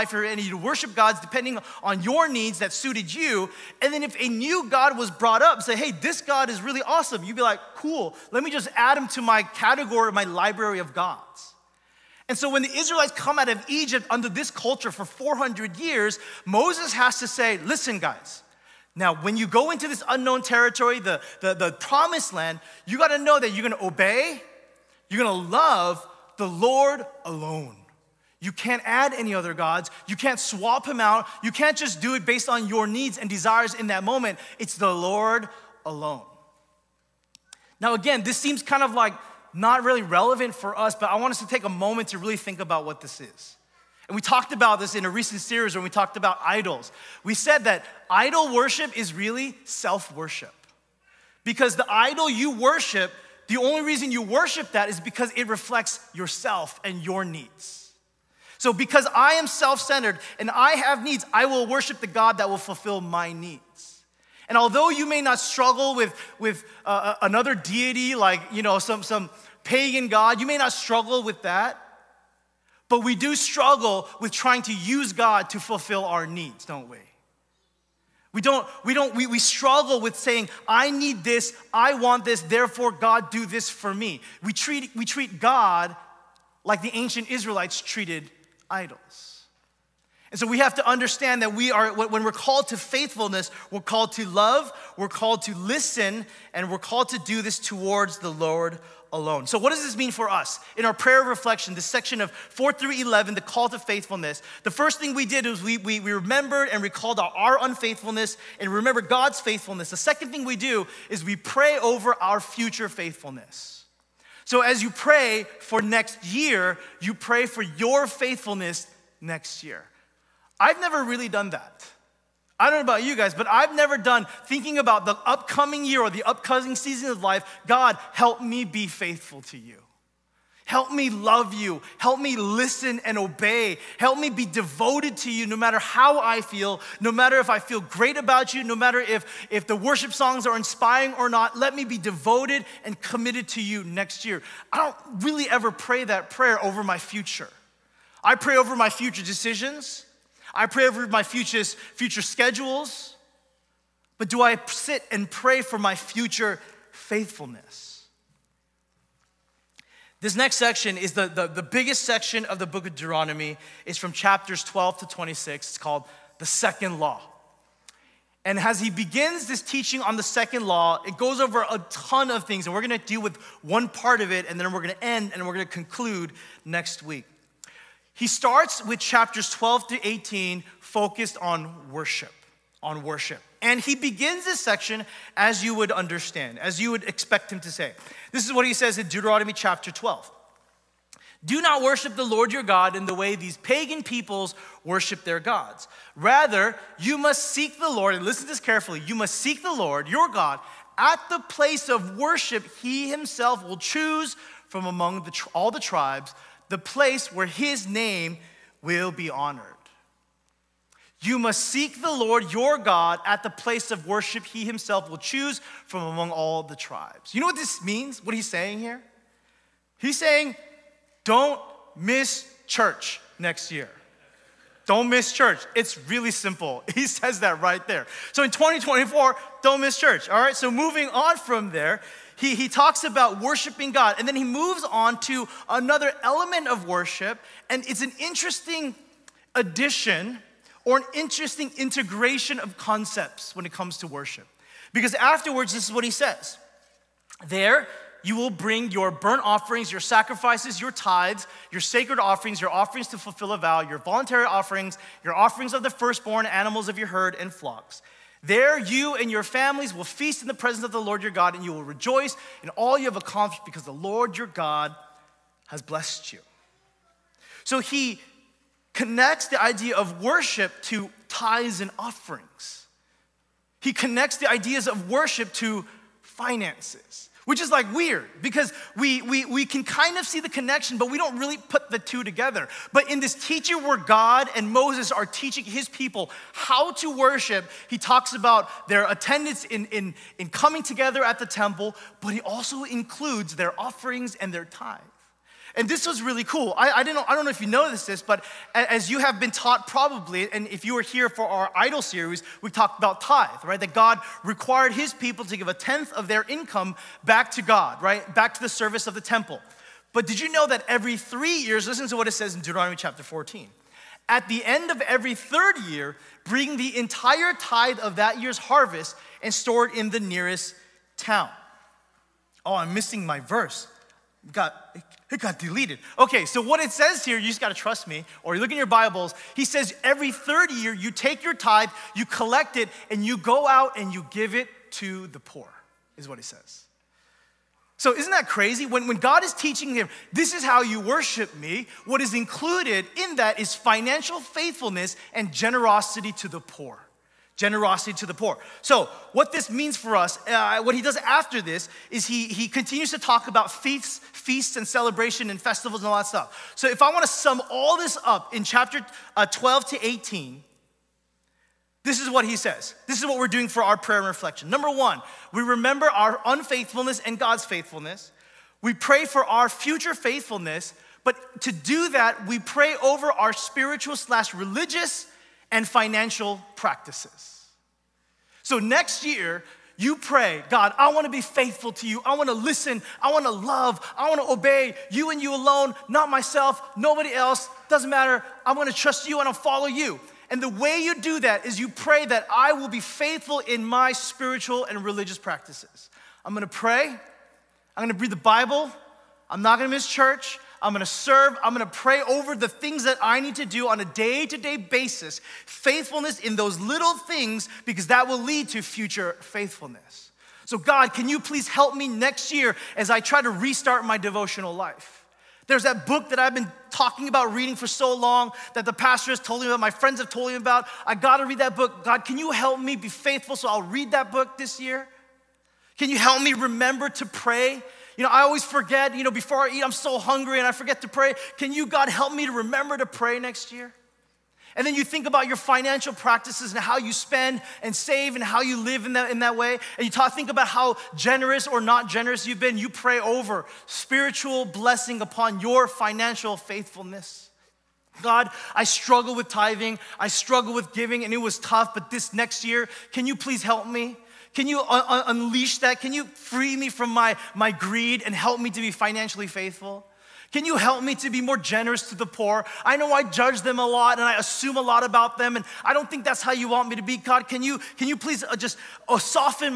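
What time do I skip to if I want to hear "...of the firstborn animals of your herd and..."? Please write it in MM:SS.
04:15.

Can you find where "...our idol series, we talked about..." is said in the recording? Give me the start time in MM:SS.
05:01.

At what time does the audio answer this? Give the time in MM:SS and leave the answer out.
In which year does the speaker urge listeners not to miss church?
03:48.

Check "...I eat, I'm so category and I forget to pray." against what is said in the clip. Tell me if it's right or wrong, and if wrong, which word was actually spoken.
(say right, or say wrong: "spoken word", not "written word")
wrong: "hungry", not "category".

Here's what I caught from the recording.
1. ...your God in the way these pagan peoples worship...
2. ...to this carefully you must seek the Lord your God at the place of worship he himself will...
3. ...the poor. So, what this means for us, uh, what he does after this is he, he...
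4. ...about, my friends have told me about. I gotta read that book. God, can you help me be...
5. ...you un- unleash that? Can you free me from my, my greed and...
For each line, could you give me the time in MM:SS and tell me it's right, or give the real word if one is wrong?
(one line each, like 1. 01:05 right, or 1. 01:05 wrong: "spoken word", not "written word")
1. 03:12 right
2. 03:18 right
3. 05:48 right
4. 06:59 right
5. 07:34 right.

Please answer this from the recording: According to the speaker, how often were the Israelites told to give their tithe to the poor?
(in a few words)
Every three years.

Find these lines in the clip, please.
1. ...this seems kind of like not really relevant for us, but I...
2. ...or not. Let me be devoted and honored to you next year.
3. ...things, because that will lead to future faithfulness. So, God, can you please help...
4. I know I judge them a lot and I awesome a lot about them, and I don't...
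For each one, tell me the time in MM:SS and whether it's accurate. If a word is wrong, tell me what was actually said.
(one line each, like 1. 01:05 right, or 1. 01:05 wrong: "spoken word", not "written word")
1. 00:38 right
2. 02:21 wrong: "committed", not "honored"
3. 06:47 right
4. 07:42 wrong: "assume", not "awesome".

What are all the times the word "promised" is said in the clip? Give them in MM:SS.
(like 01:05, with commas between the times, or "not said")
00:21.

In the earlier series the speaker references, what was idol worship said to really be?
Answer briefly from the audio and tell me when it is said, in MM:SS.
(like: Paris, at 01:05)
Self worship, at 00:49.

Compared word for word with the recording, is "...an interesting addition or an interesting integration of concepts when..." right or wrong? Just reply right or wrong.
right.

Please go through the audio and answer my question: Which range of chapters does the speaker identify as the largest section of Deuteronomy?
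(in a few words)
12 to 26.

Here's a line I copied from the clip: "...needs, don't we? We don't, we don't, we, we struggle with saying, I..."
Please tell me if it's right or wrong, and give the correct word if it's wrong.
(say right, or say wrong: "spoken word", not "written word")
right.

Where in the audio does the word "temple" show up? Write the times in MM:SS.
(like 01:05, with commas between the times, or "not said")
04:51, 05:09.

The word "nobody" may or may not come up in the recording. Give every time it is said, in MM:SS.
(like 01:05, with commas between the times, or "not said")
06:26.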